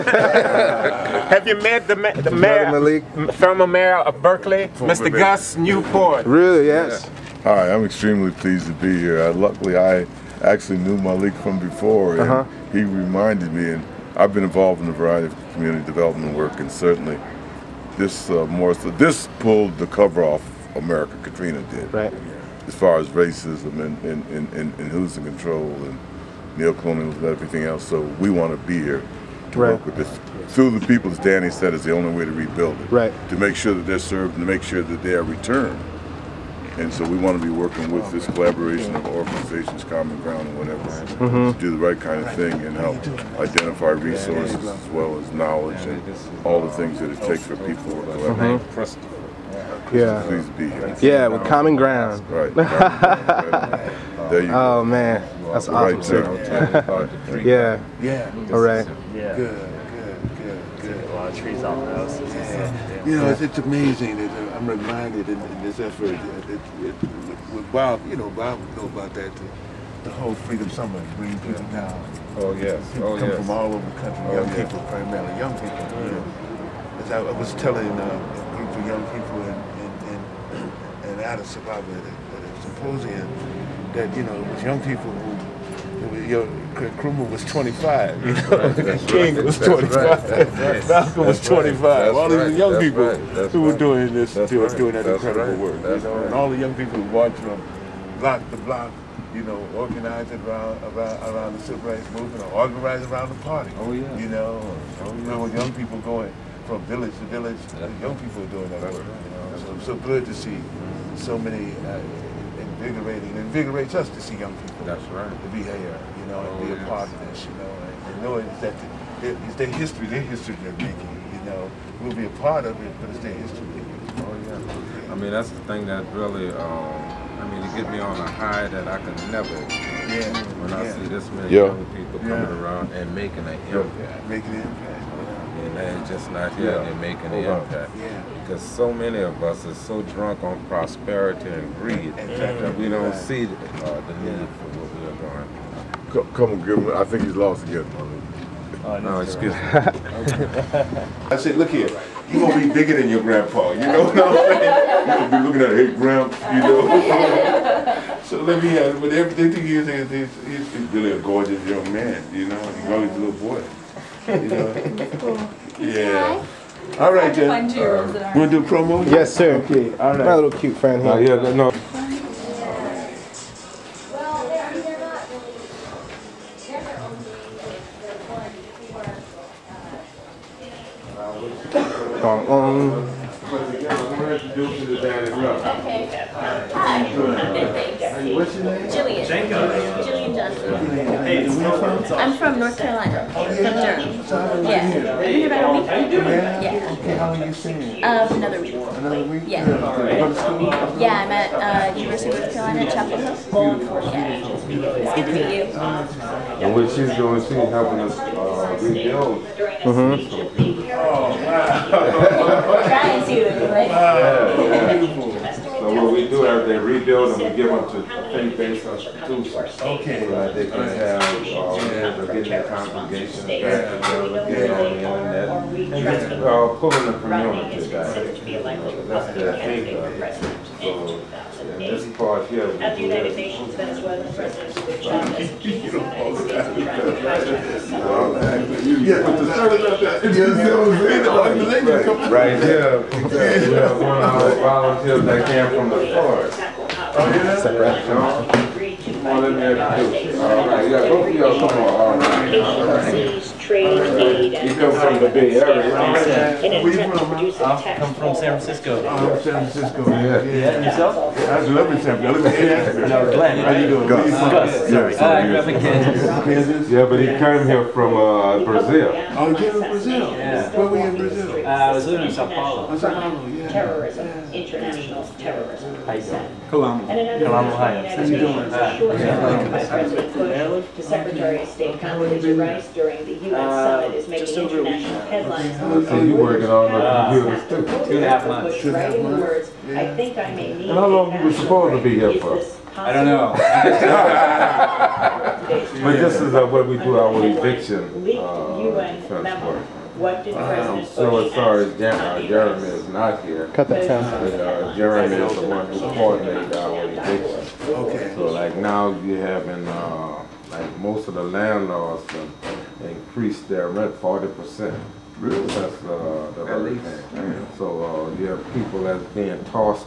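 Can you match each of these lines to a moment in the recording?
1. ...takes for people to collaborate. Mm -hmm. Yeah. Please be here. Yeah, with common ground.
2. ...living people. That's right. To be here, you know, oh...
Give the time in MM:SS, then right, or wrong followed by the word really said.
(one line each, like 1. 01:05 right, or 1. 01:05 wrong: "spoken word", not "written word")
1. 00:47 right
2. 01:54 wrong: "young", not "living".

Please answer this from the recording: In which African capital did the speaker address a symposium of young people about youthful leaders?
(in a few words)
Addis Ababa.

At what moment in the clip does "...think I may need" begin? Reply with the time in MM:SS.
04:50.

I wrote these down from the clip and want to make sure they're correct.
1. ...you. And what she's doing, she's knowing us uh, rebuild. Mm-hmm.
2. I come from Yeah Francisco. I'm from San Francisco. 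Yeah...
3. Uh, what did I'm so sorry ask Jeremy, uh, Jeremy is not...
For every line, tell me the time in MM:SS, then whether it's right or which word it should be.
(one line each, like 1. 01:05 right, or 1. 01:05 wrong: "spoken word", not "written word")
1. 03:23 wrong: "helping", not "knowing"
2. 04:15 wrong: "San", not "Yeah"
3. 04:58 right.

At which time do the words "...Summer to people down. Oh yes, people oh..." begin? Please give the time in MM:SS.
01:10.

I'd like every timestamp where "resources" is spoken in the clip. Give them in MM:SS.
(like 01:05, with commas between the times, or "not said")
00:44.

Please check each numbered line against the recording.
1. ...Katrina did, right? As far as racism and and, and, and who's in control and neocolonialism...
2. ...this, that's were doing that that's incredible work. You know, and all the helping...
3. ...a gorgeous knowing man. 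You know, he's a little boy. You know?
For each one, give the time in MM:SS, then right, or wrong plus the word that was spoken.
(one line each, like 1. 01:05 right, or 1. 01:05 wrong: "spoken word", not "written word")
1. 00:21 right
2. 01:34 wrong: "young", not "helping"
3. 02:41 wrong: "young", not "knowing".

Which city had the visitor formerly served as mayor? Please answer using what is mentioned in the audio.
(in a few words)
Berkeley.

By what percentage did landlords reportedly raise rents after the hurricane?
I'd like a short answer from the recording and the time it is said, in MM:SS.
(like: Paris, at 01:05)
40%, at 05:14.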